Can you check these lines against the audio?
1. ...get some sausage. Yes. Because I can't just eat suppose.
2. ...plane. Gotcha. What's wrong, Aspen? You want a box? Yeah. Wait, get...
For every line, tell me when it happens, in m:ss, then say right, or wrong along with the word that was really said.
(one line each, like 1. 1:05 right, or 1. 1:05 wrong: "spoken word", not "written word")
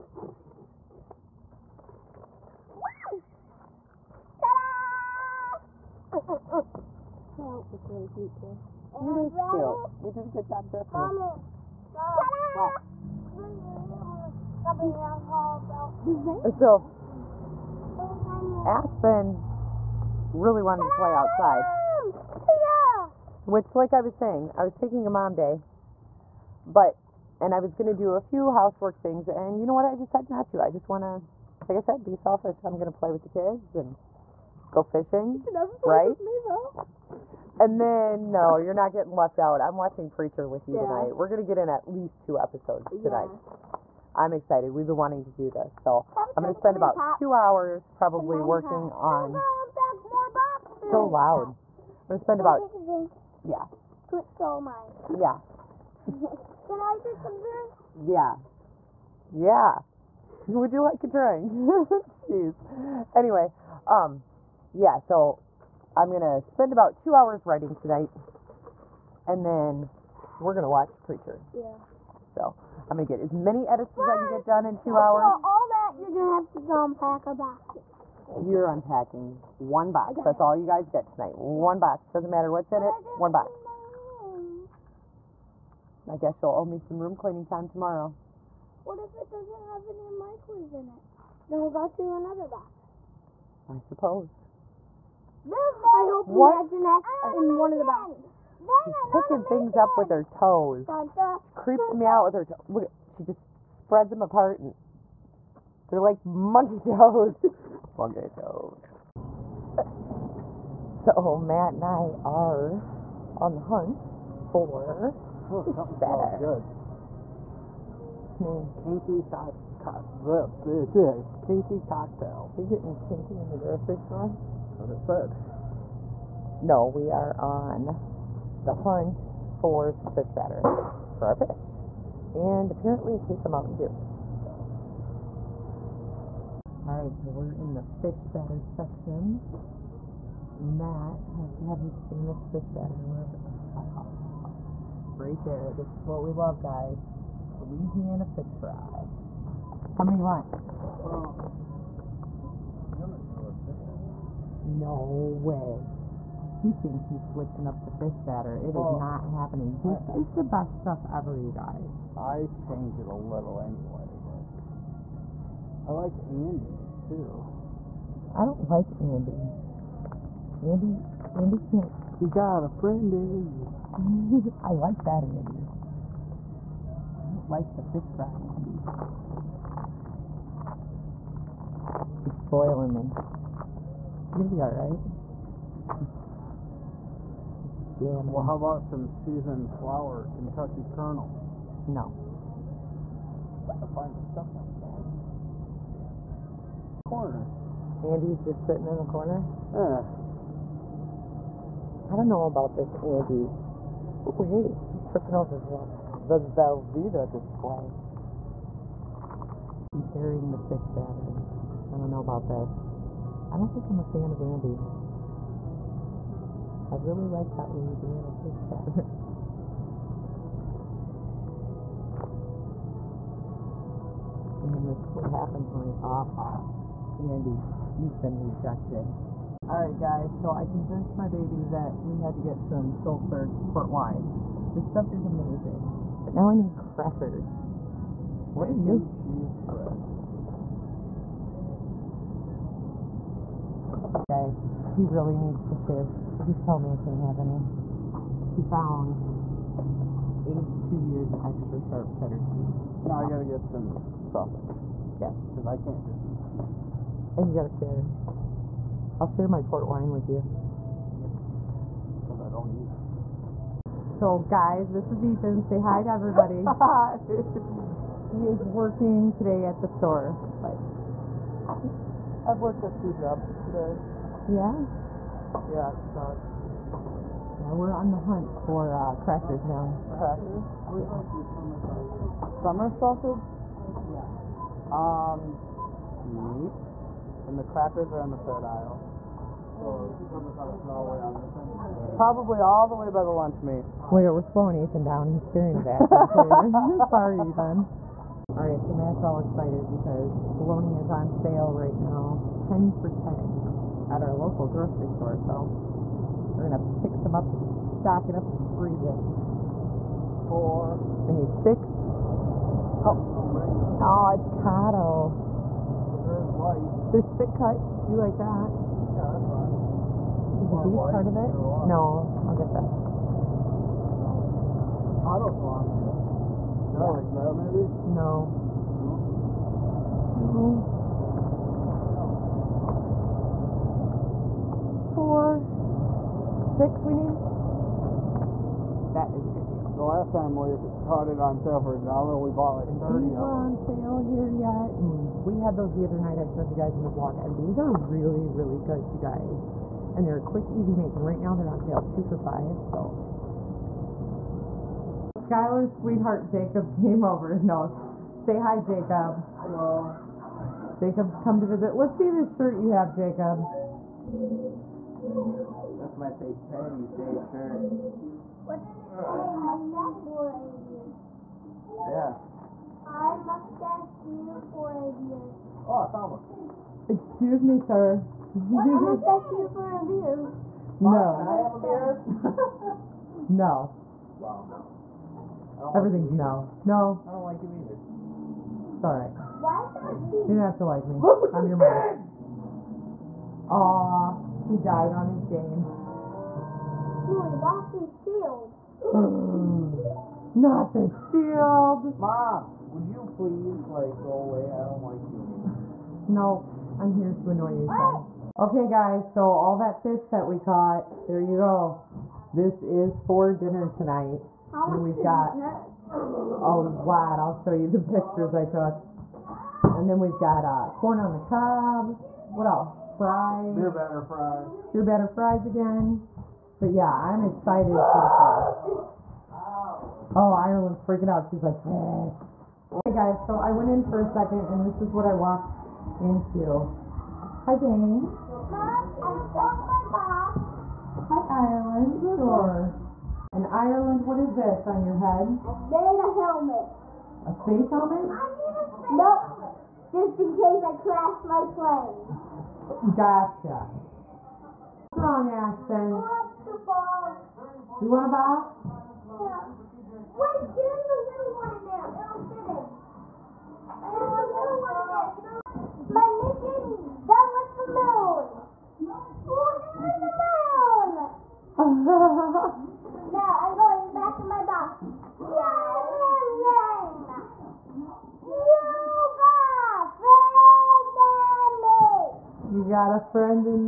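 1. 4:13 wrong: "cheese", not "suppose"
2. 7:31 right.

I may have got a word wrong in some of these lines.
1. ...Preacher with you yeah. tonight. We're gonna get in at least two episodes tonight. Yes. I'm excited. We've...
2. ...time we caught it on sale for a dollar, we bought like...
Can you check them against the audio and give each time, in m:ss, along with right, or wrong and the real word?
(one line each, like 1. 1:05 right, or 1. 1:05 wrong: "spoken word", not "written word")
1. 0:40 right
2. 5:40 right.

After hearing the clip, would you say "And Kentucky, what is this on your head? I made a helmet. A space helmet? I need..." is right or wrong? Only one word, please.
wrong.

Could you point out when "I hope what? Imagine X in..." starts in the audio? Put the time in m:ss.
1:35.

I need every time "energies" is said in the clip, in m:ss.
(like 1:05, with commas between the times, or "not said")
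not said.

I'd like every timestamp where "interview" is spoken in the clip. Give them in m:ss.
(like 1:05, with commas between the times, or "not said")
not said.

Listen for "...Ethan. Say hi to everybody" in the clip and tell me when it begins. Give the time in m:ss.
4:25.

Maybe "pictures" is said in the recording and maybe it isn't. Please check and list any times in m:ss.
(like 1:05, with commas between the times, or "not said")
6:57.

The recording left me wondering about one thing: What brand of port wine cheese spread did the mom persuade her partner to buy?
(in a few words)
Shullsburg.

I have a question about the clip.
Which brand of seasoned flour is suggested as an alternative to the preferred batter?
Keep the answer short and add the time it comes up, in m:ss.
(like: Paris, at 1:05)
Kentucky Kernel, at 3:10.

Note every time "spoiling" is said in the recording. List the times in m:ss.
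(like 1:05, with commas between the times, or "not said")
3:02.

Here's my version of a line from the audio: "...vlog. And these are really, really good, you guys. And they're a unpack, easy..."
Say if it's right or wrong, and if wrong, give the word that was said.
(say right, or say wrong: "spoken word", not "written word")
wrong: "quick", not "unpack".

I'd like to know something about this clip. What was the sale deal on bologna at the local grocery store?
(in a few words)
10 for 10.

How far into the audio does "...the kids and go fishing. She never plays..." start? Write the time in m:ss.
0:33.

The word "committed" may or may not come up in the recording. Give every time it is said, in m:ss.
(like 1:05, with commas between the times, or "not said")
not said.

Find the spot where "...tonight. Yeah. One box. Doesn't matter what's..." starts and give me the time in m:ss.
1:21.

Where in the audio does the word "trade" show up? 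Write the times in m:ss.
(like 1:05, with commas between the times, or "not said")
not said.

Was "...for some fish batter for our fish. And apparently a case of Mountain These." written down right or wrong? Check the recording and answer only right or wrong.
wrong.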